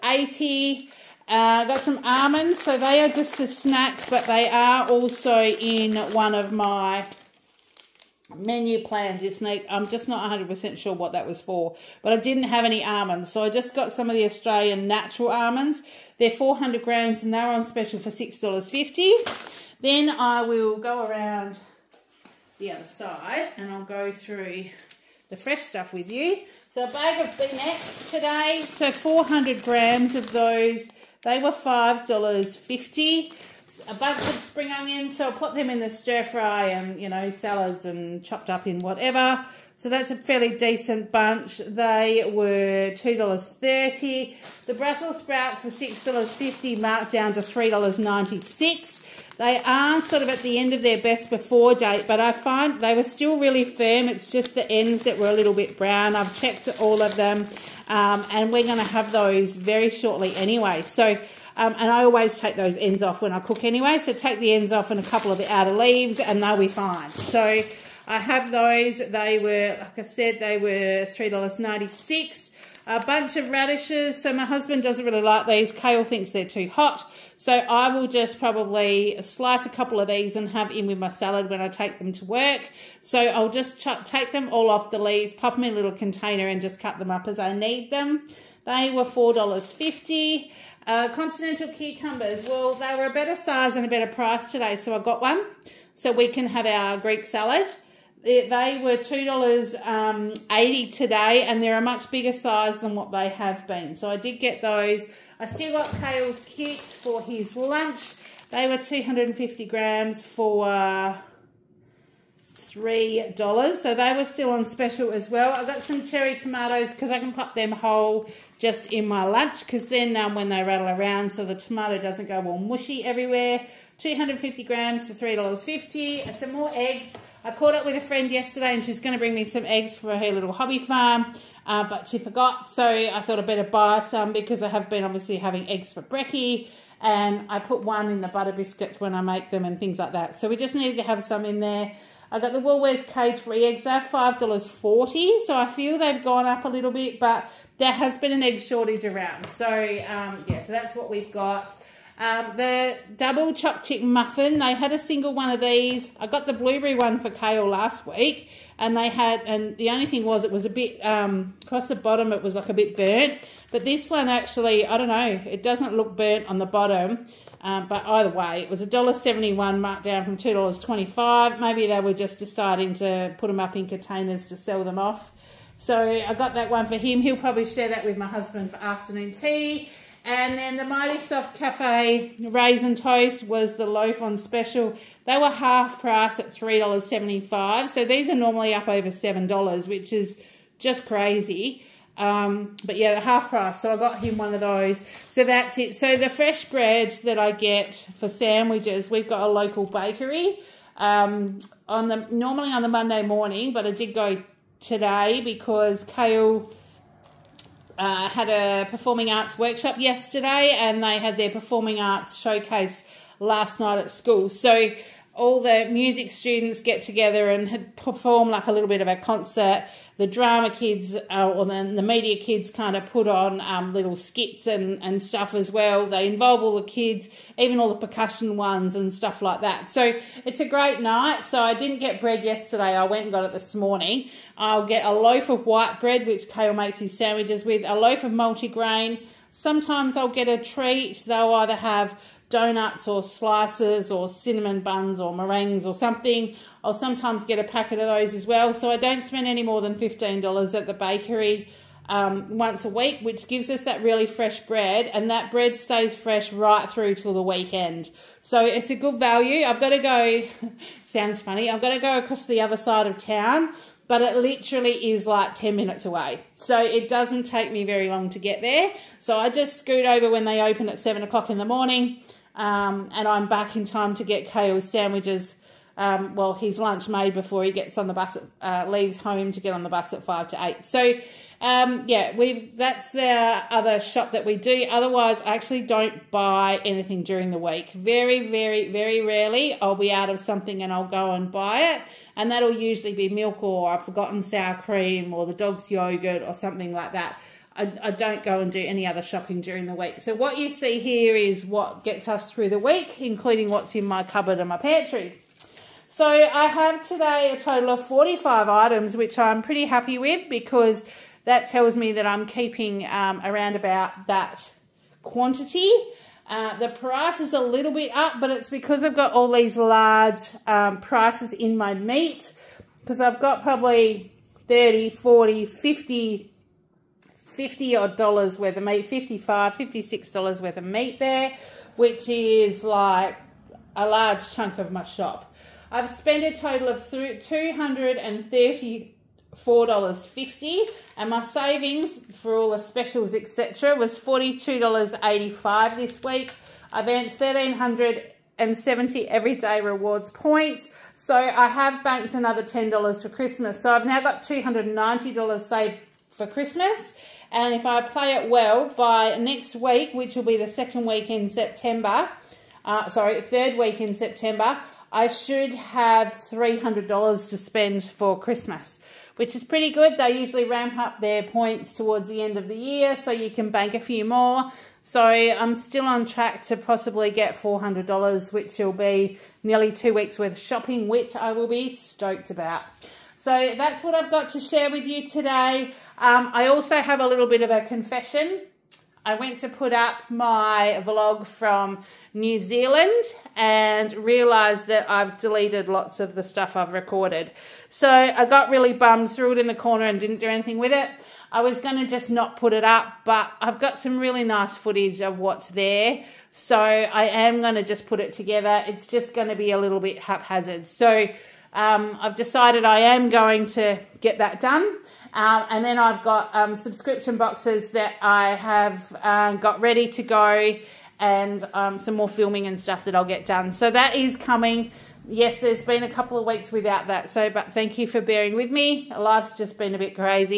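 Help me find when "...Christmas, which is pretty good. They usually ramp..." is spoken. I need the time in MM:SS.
06:08.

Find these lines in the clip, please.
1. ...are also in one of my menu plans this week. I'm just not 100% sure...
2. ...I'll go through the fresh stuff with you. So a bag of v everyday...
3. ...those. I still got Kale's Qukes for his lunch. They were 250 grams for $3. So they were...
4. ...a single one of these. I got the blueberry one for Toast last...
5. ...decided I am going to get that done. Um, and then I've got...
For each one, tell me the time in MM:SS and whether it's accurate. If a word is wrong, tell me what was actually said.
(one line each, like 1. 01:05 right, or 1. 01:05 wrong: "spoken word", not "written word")
1. 00:04 right
2. 00:23 wrong: "today", not "everyday"
3. 01:44 right
4. 02:34 wrong: "Kale", not "Toast"
5. 06:52 right.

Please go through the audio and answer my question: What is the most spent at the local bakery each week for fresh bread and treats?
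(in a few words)
$15.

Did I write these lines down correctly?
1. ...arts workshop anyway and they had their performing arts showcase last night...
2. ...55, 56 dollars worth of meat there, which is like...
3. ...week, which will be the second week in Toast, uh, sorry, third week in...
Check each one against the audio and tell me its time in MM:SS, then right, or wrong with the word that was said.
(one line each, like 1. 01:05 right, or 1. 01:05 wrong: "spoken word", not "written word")
1. 03:29 wrong: "yesterday", not "anyway"
2. 05:29 right
3. 05:59 wrong: "September", not "Toast".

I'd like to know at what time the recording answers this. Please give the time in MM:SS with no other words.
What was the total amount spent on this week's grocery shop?
05:37.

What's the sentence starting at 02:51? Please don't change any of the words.
Maybe they were just deciding to put them up in containers to sell them off.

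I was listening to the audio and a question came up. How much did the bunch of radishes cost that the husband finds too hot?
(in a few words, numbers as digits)
$4.50.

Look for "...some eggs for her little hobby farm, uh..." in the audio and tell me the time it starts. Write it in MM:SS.
02:09.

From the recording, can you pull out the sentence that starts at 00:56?
I've checked all of them, um, and we're going to have those very shortly anyway.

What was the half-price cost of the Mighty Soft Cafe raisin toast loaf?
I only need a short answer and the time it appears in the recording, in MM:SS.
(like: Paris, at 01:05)
$3.75, at 03:06.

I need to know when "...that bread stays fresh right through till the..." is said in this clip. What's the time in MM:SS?
04:15.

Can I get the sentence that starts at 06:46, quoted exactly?
So I am going to just put it together.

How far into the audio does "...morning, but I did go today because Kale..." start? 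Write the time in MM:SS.
03:23.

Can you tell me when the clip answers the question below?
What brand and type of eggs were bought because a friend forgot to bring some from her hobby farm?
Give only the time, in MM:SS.
02:22.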